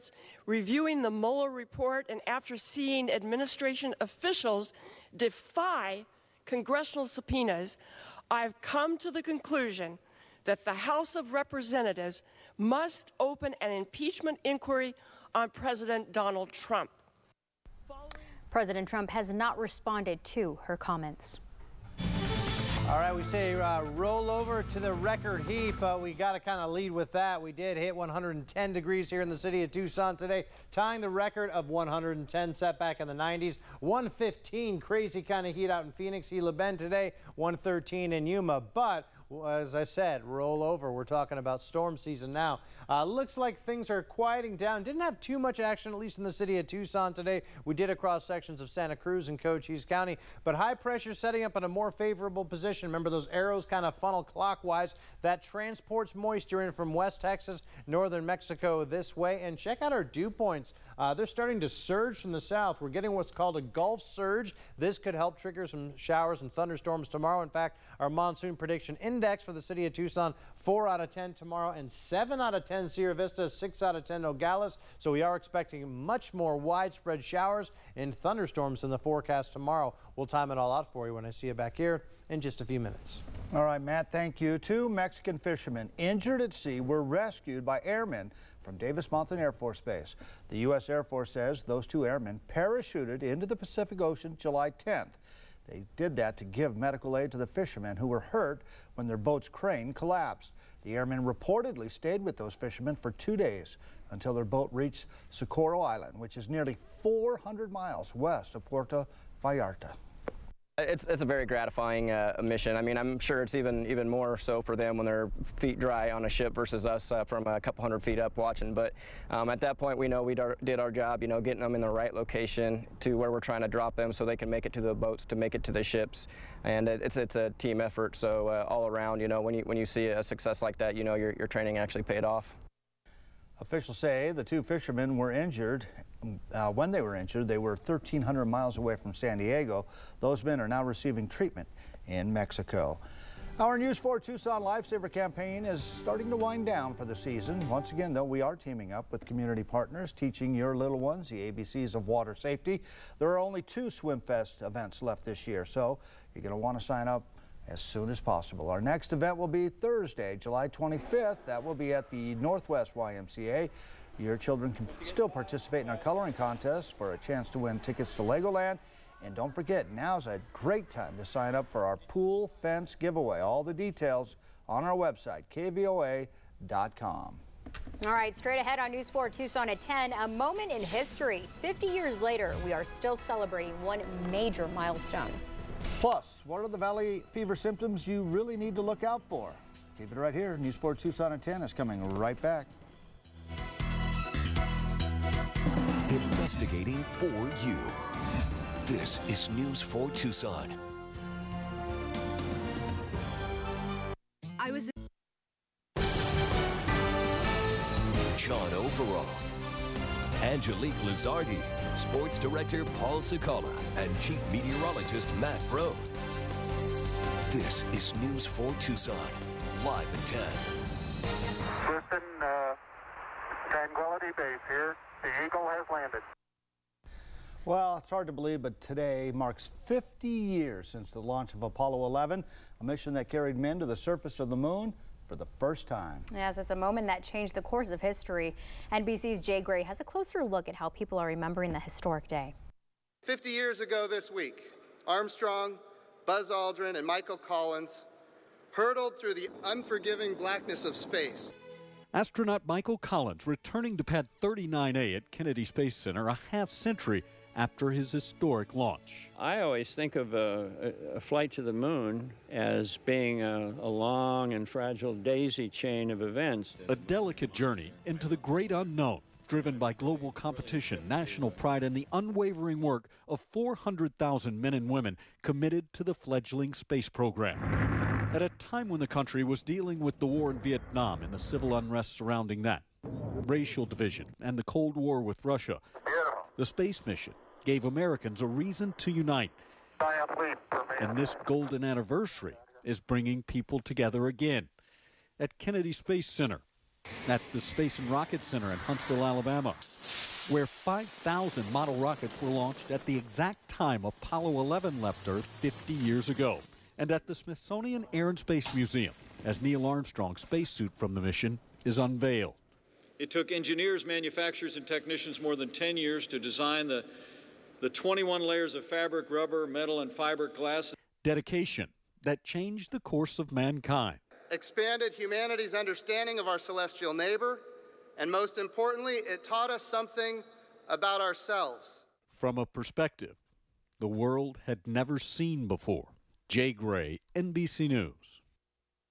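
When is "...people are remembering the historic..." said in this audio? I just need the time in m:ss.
4:00.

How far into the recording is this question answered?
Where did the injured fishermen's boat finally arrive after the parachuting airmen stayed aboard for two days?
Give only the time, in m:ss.
1:45.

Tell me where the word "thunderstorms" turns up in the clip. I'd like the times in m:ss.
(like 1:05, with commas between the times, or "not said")
1:06, 1:18.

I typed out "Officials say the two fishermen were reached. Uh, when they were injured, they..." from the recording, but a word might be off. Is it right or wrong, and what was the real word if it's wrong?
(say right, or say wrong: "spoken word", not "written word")
wrong: "injured", not "reached".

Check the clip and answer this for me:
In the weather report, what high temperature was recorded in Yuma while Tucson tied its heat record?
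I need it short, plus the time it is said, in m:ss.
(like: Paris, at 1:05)
113, at 0:37.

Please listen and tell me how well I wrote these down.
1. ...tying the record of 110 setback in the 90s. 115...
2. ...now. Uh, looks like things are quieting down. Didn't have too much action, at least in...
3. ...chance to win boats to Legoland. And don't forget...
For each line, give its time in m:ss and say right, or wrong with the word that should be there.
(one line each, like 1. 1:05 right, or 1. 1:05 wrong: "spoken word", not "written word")
1. 0:30 right
2. 0:42 right
3. 2:47 wrong: "tickets", not "boats".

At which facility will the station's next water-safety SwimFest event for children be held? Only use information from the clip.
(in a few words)
Northwest YMCA.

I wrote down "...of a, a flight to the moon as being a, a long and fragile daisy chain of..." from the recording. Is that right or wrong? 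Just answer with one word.
right.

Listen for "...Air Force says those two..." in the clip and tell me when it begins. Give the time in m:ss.
1:30.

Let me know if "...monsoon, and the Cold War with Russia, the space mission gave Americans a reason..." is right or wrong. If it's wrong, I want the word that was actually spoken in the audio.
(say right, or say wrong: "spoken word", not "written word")
wrong: "division", not "monsoon".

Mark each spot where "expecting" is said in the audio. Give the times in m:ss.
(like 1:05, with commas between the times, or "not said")
1:15.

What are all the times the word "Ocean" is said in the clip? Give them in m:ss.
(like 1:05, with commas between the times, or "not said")
1:34.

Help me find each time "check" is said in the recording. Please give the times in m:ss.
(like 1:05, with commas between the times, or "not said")
0:59.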